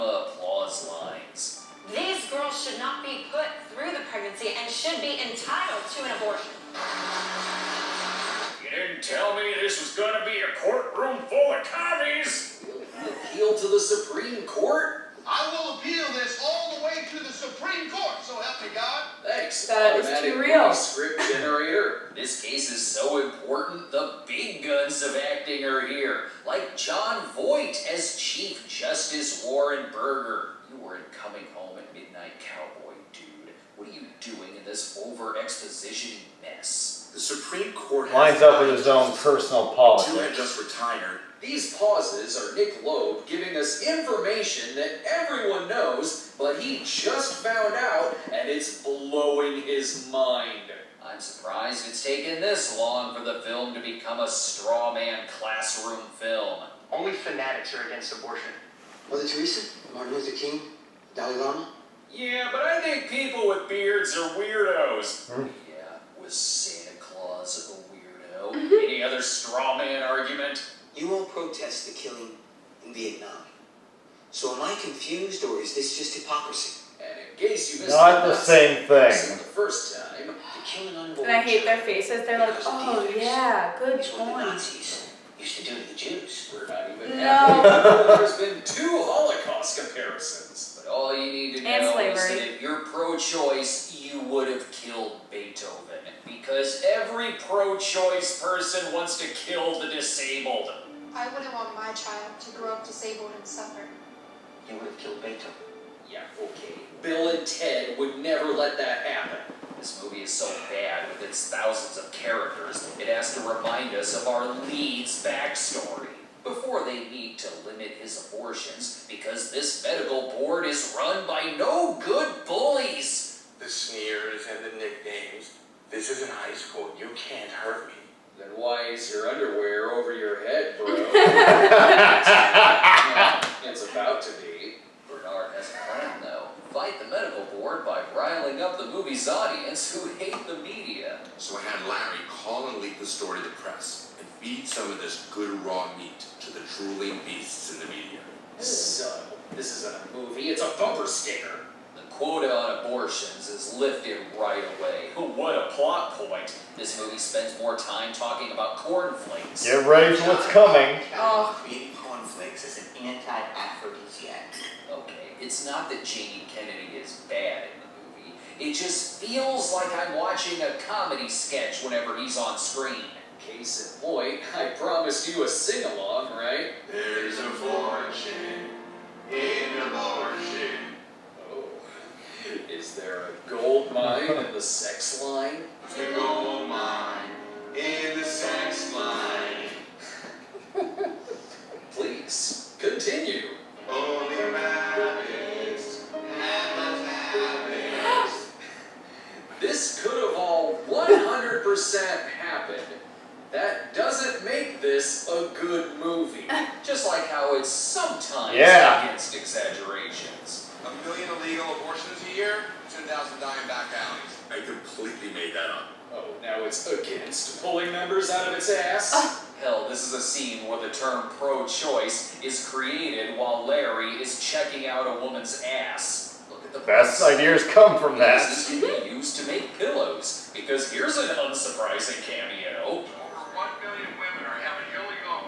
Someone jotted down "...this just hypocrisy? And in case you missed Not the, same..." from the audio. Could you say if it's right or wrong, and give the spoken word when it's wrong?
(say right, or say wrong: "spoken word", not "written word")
right.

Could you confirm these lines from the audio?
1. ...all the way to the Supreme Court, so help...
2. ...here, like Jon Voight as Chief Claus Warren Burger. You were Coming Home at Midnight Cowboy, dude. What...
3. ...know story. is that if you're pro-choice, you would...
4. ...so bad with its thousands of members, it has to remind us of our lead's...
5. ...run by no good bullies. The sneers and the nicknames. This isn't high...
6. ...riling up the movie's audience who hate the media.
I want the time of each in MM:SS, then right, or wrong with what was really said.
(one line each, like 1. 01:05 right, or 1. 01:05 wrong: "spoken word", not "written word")
1. 00:16 right
2. 00:25 wrong: "Justice", not "Claus"
3. 01:31 wrong: "slavery", not "story"
4. 01:50 wrong: "characters", not "members"
5. 02:00 right
6. 02:18 right.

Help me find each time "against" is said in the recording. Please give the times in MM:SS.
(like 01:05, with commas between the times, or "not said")
00:57, 03:29, 03:36.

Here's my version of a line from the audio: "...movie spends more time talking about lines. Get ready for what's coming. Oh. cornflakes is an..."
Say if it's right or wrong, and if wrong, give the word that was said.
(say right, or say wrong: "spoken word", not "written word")
wrong: "cornflakes", not "lines".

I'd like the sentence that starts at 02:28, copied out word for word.
So, this isn't a movie, it's a bumper sticker.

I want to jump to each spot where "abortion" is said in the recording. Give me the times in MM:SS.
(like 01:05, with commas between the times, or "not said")
00:06, 00:58, 01:58, 02:32, 02:59, 03:31.